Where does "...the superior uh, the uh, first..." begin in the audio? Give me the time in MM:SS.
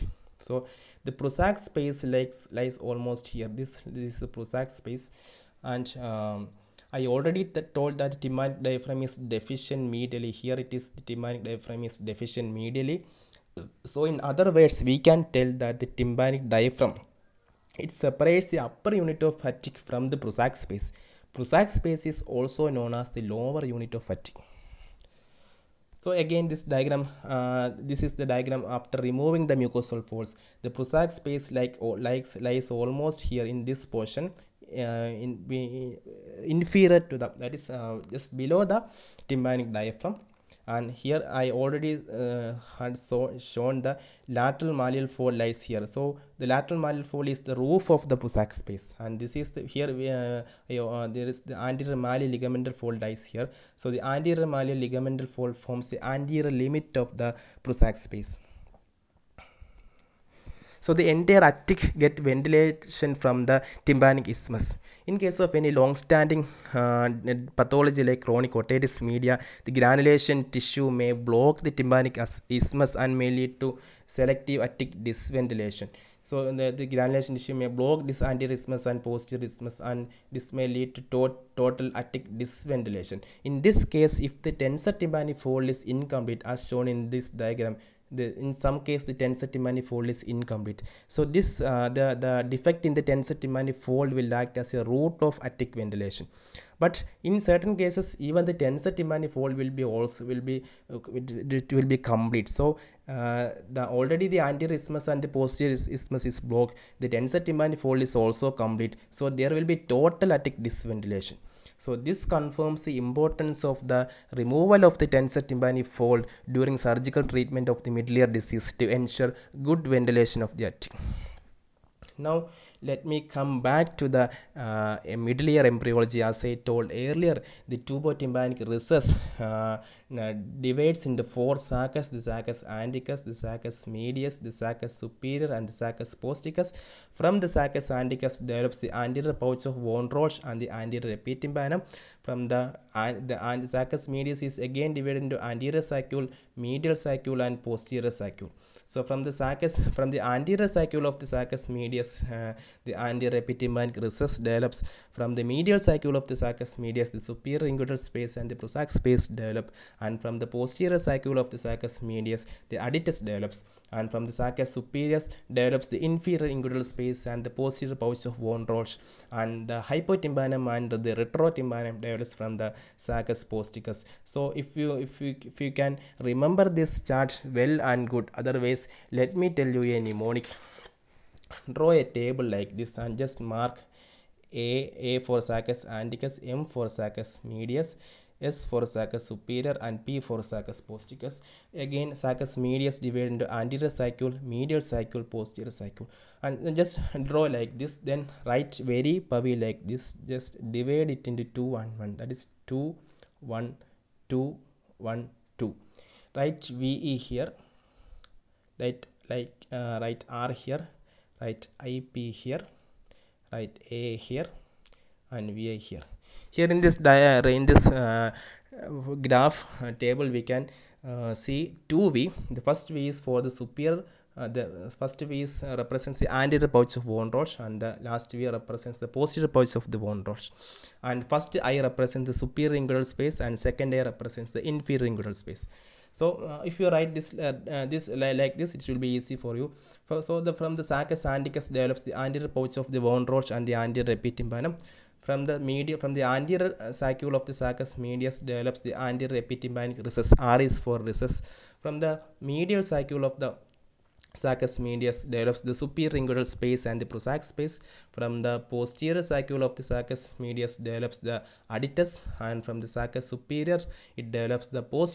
03:43.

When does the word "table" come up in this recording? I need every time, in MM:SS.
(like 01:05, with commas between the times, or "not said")
03:02, 03:40.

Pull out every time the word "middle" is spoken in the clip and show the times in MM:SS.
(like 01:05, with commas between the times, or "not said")
01:57, 02:05.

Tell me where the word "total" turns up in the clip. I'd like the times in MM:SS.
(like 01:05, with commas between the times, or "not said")
01:21, 01:49.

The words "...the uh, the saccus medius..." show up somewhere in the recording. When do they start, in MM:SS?
02:22.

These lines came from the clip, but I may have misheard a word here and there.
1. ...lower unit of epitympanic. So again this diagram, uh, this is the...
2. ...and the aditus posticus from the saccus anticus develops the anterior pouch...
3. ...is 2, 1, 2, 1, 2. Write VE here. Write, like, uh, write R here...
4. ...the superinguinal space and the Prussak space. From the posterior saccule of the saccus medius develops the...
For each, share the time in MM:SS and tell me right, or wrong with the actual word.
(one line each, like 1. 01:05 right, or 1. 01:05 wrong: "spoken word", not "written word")
1. 00:23 wrong: "attic", not "epitympanic"
2. 02:15 wrong: "saccus", not "aditus"
3. 03:22 right
4. 04:15 right.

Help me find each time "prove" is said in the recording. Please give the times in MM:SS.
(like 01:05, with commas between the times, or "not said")
not said.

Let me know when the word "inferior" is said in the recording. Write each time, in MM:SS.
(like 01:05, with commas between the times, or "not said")
00:36, 02:46, 03:54.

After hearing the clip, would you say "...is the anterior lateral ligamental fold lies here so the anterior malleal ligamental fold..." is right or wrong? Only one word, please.
wrong.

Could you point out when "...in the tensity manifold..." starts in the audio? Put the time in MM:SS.
01:32.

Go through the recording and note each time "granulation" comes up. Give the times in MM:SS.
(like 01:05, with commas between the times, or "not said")
01:09, 01:16.